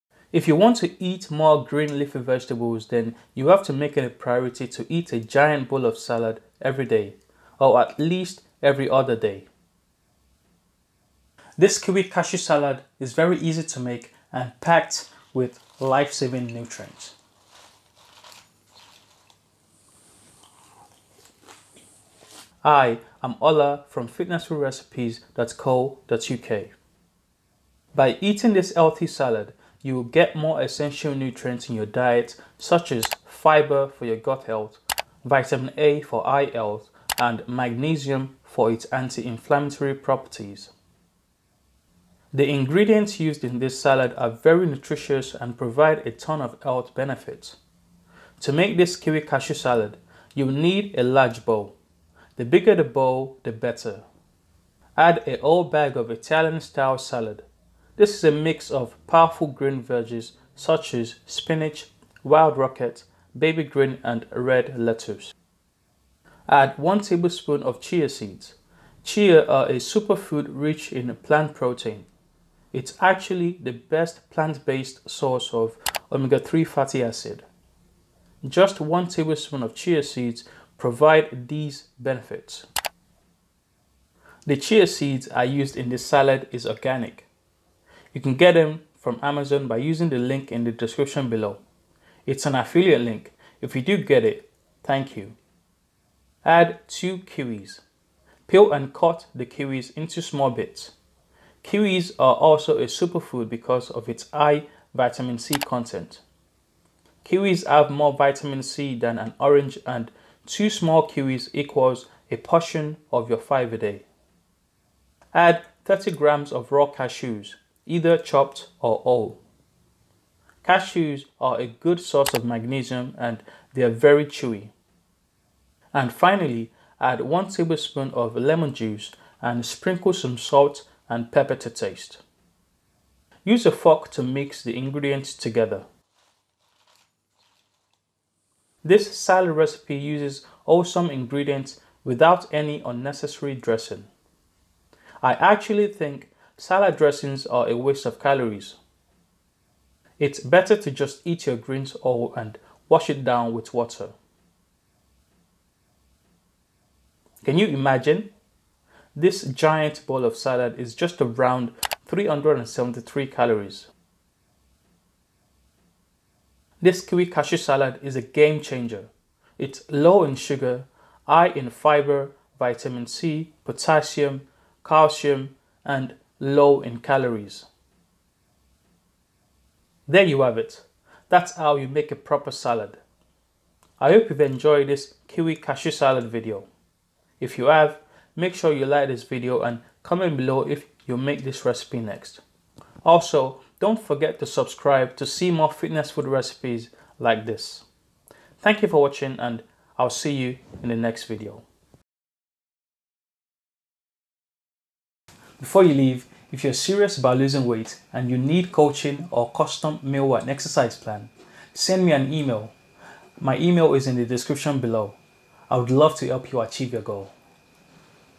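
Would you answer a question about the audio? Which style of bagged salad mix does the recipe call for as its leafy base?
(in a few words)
Italian style.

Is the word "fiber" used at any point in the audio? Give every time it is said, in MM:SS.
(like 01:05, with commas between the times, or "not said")
00:33, 02:51.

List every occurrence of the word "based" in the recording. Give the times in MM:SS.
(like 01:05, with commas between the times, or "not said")
01:14.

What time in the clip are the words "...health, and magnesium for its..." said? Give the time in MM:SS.
00:36.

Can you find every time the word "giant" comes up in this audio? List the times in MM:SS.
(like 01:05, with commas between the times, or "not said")
00:05, 02:39.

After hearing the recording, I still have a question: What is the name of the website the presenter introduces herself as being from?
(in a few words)
fitnessfoodrecipes.co.uk.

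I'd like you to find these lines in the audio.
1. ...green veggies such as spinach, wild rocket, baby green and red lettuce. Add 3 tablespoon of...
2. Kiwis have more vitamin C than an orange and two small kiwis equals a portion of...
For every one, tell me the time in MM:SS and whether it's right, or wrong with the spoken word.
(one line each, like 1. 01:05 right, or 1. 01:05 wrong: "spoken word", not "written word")
1. 00:59 wrong: "1", not "3"
2. 01:47 right.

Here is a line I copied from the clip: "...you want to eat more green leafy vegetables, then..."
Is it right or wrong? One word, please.
right.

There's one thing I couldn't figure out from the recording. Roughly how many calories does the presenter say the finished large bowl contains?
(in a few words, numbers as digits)
373.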